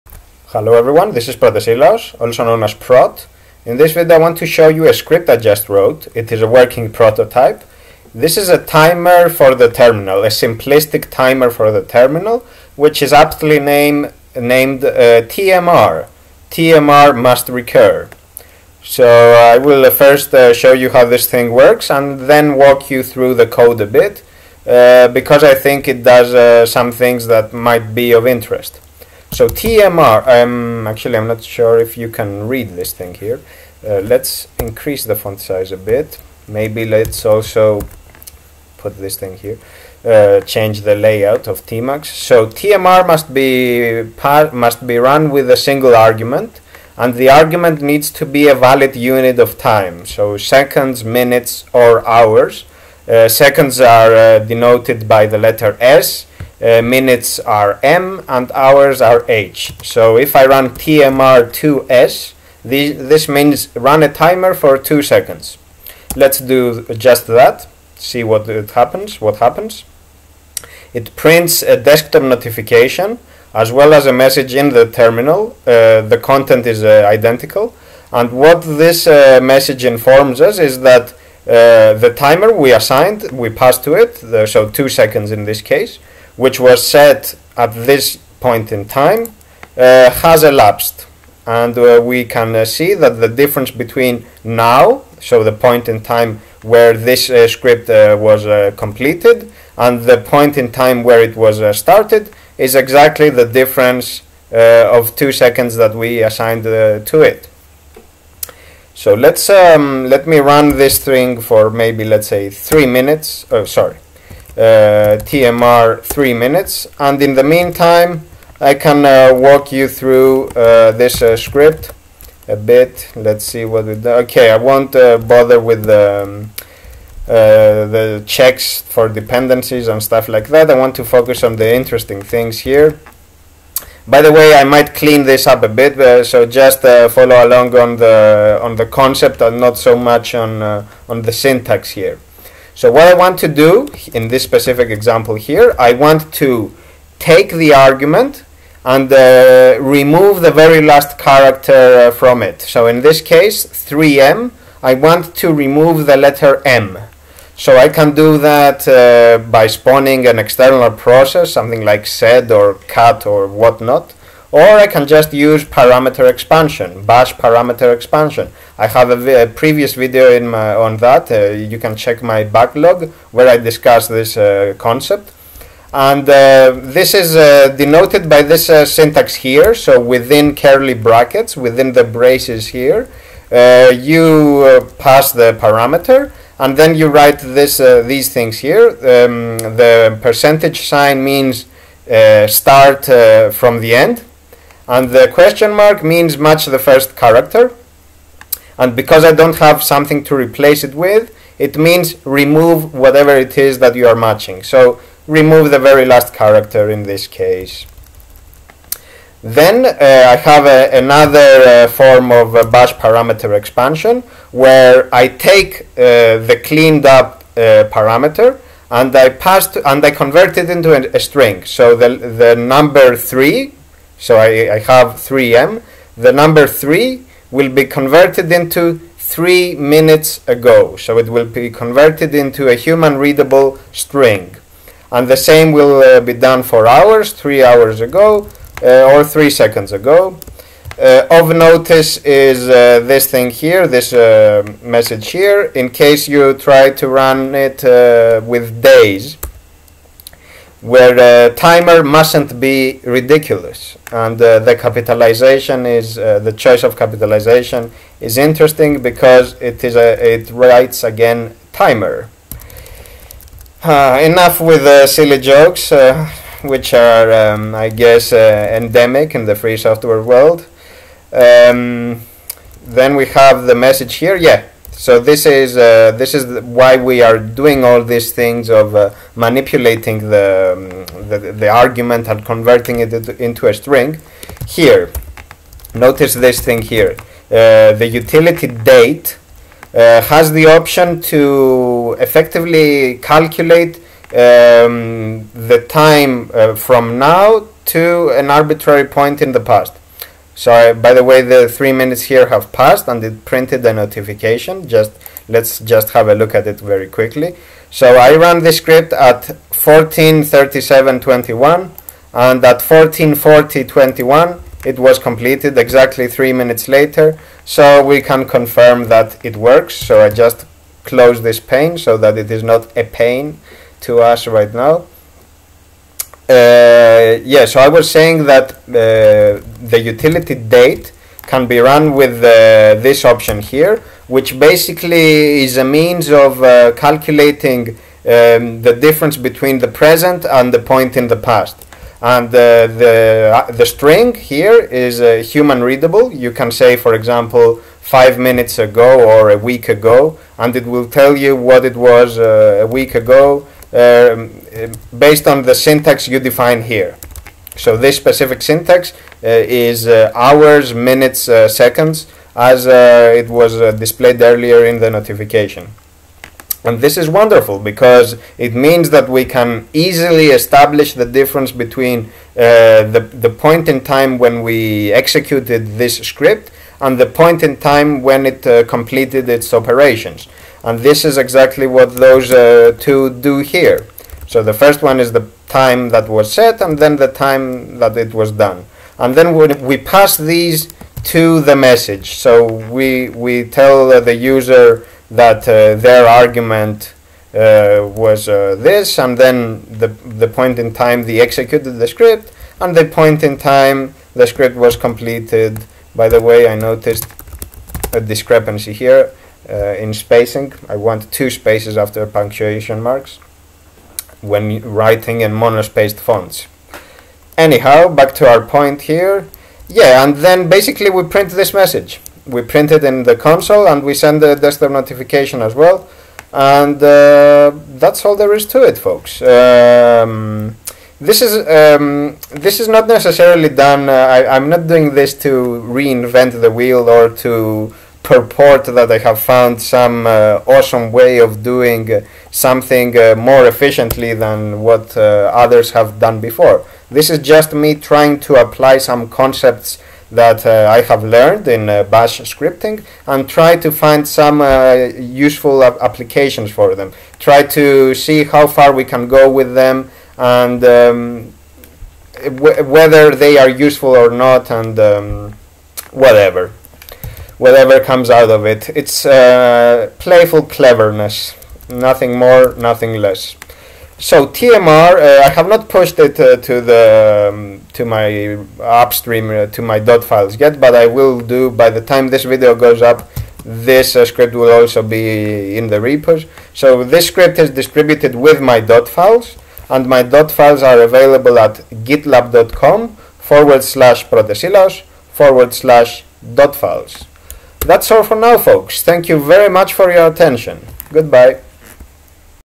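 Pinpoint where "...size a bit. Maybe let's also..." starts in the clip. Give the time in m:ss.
0:35.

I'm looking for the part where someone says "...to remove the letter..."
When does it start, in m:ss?
2:35.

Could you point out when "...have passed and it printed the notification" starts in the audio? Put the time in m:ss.
5:02.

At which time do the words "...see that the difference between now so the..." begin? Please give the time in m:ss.
1:32.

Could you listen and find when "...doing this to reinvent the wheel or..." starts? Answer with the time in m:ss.
7:14.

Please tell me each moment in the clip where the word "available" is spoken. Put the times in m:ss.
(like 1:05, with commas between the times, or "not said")
8:11.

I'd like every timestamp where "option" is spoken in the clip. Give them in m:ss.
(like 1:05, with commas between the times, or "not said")
4:50, 5:33.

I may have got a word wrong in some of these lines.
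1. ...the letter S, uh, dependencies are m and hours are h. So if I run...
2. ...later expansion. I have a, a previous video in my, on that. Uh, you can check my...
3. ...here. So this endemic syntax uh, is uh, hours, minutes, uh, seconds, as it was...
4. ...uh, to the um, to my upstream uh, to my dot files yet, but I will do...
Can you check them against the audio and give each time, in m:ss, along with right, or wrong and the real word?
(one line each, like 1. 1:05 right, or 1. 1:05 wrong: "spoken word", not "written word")
1. 0:55 wrong: "minutes", not "dependencies"
2. 2:47 wrong: "parameter", not "later"
3. 5:56 wrong: "specific", not "endemic"
4. 7:56 right.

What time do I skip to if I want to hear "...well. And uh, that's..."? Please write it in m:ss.
7:05.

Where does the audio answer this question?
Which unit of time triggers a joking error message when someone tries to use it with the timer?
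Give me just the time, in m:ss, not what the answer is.
4:08.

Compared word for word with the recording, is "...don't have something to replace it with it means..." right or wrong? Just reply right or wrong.
right.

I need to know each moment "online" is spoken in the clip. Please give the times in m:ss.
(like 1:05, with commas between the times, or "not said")
not said.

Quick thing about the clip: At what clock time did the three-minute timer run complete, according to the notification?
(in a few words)
14:40:21.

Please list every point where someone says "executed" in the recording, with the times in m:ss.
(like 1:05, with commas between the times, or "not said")
6:15, 6:41.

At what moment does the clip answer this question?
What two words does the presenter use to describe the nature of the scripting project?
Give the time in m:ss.
7:50.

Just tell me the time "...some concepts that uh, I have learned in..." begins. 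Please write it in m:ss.
7:28.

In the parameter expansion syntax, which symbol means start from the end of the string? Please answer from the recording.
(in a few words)
percentage sign.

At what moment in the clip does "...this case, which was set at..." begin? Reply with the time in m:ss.
1:25.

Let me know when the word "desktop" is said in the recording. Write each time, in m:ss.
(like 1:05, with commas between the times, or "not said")
1:11, 7:04.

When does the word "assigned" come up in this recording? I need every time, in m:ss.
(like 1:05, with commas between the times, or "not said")
1:22, 1:46.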